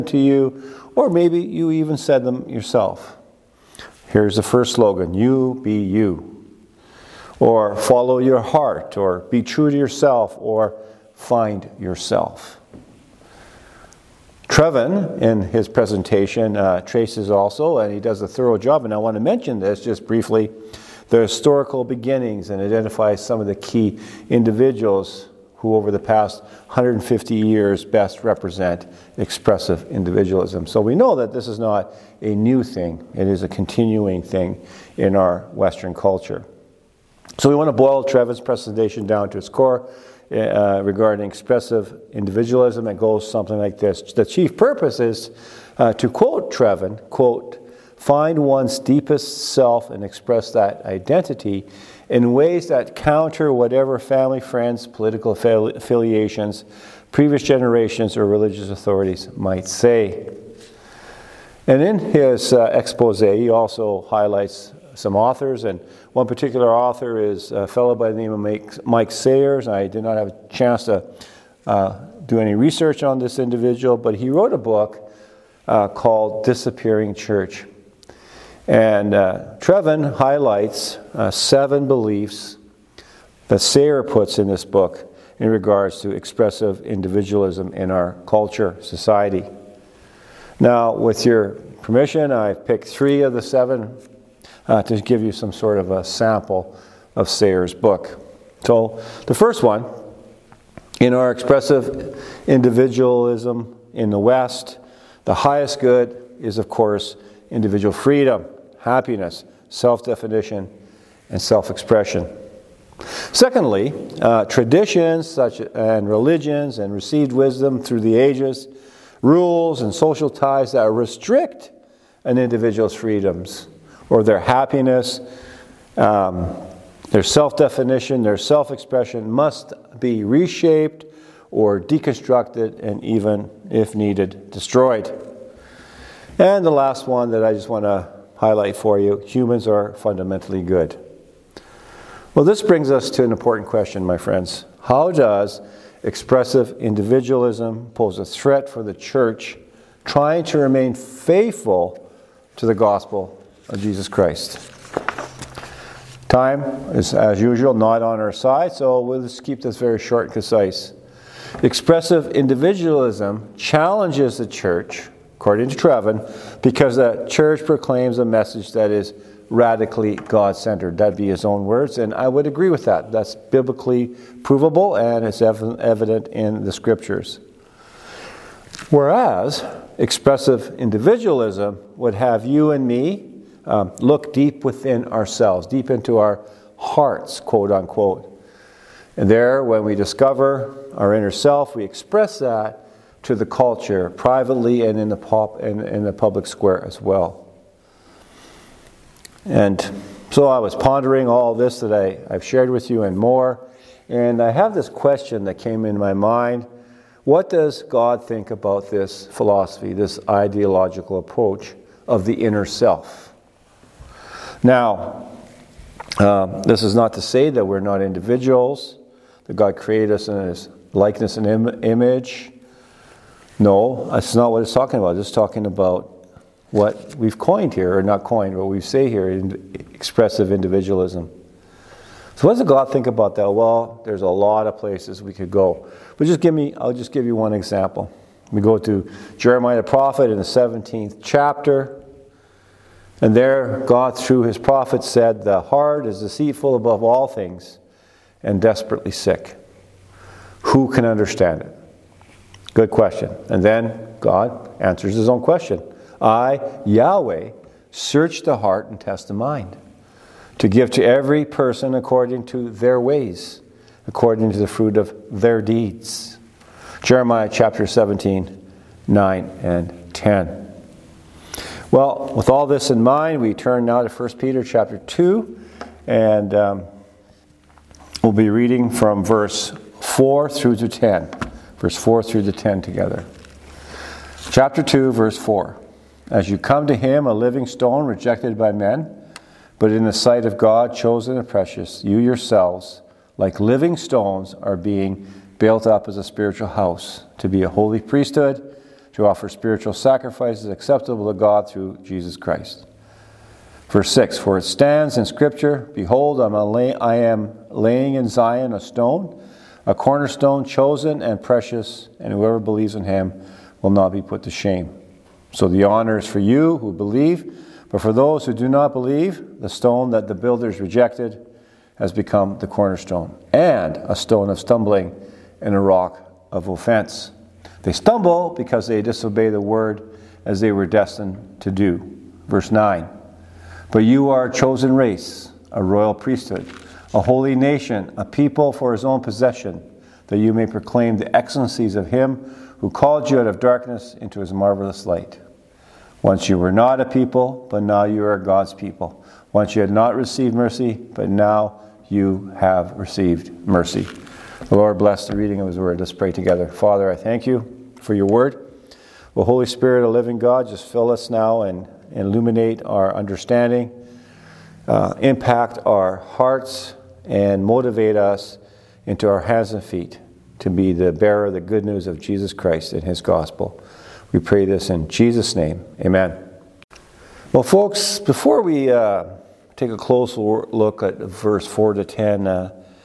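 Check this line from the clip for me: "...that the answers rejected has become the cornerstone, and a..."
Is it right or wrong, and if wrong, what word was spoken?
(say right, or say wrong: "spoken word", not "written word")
wrong: "builders", not "answers".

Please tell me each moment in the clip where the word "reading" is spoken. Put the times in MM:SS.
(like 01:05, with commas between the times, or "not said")
04:38, 05:55.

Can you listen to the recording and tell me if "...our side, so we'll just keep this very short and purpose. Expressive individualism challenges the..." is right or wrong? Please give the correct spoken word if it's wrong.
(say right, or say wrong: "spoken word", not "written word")
wrong: "concise", not "purpose".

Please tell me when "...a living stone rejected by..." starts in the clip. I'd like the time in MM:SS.
04:47.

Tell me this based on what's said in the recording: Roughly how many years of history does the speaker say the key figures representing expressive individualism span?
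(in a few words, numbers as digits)
150 years.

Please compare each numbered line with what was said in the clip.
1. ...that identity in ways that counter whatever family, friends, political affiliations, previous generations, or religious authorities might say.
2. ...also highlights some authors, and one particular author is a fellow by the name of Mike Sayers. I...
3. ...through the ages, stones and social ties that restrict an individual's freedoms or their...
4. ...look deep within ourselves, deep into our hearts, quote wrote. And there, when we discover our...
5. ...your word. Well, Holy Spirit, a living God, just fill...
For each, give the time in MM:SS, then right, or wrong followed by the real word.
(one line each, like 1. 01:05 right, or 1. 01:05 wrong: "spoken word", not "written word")
1. 00:50 right
2. 01:03 right
3. 01:57 wrong: "rules", not "stones"
4. 03:03 wrong: "unquote", not "wrote"
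5. 05:58 right.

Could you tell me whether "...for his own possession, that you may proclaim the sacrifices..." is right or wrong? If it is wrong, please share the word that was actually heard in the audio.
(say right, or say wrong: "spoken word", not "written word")
wrong: "excellencies", not "sacrifices".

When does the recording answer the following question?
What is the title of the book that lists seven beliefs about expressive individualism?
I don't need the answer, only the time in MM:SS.
01:16.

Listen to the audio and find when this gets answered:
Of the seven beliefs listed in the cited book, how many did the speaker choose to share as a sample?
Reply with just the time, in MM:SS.
01:32.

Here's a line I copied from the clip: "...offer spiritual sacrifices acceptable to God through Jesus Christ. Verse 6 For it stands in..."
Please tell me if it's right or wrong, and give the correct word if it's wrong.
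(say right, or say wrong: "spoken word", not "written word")
right.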